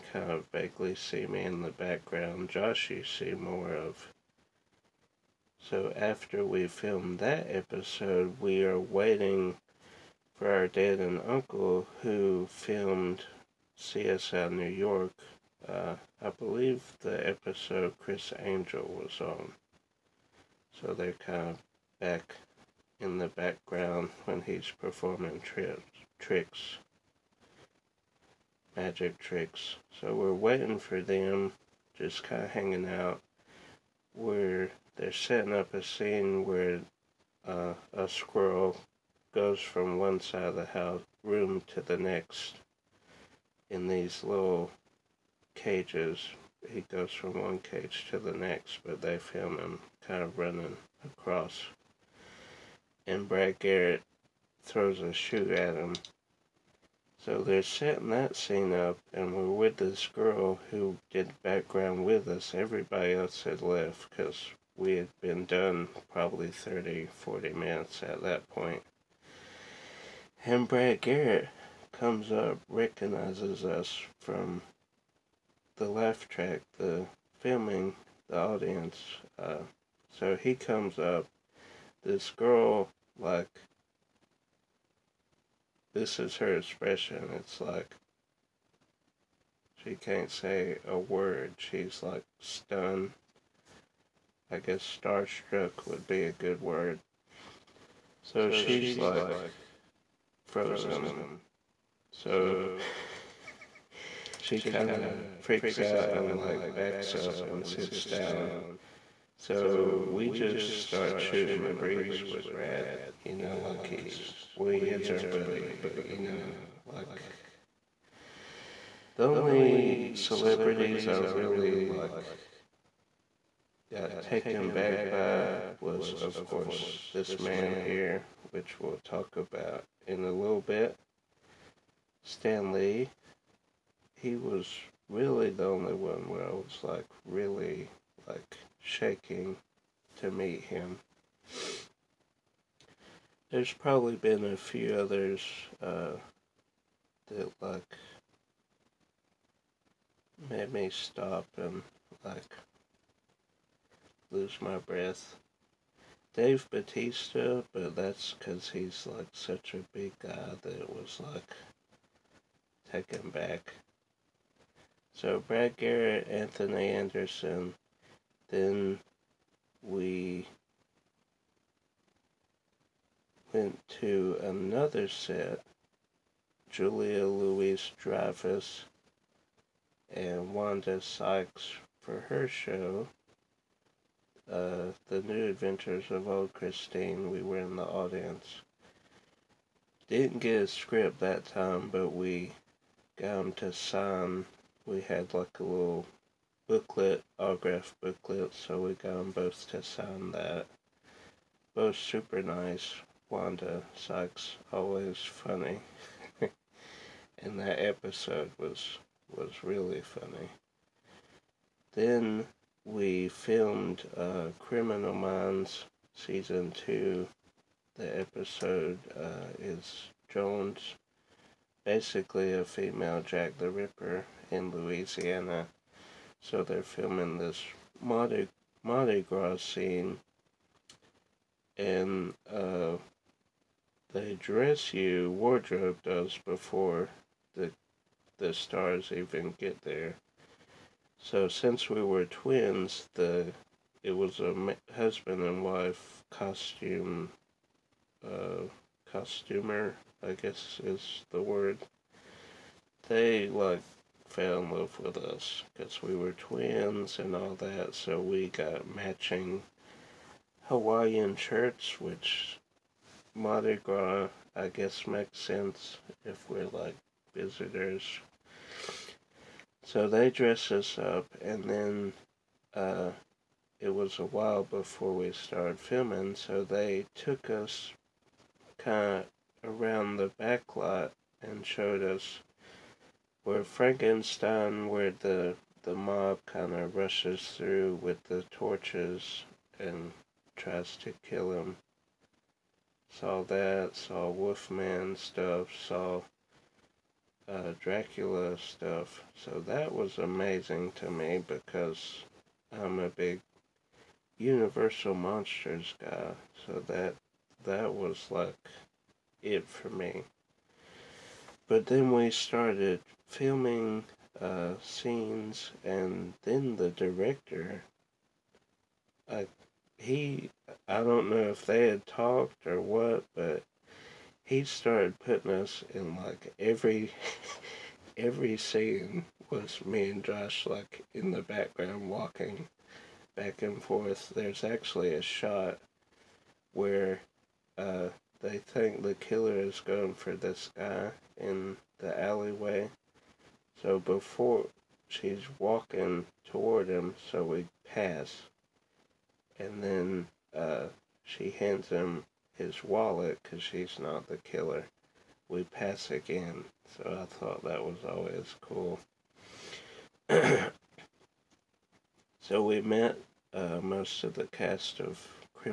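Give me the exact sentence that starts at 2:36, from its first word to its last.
Dave Batista, but that's because he's like such a big guy that it was like taken back.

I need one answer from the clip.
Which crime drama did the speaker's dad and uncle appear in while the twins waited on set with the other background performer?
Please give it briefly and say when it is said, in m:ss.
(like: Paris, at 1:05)
CSI New York, at 0:13.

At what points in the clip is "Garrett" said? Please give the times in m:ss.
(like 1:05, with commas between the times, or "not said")
0:53, 1:10, 2:45.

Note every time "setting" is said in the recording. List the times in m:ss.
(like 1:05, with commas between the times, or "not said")
0:35, 0:57.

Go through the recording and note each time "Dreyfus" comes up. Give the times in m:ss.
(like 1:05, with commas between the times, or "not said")
2:57.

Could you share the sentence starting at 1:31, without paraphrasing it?
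She's like stunned I guess starstruck would be a good word.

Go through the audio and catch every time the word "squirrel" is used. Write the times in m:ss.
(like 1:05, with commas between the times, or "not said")
0:38.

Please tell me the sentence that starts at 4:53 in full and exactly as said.
Saw that, saw Wolfman stuff, saw uh, Dracula stuff.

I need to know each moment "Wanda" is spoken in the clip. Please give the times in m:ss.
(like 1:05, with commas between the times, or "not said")
3:00, 3:23.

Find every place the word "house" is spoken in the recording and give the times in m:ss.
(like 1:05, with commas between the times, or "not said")
0:40.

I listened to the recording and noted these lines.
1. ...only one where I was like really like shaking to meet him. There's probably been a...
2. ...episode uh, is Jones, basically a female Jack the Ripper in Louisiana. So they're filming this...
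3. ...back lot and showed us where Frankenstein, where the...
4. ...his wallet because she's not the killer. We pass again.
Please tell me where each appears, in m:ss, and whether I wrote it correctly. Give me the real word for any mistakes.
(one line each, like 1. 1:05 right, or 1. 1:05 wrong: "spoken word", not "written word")
1. 2:15 right
2. 3:38 right
3. 4:40 right
4. 5:52 right.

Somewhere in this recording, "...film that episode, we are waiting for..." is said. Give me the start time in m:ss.
0:06.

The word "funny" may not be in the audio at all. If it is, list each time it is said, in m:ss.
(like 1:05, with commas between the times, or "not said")
3:25, 3:30.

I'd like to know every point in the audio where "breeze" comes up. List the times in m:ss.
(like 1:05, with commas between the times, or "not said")
1:51.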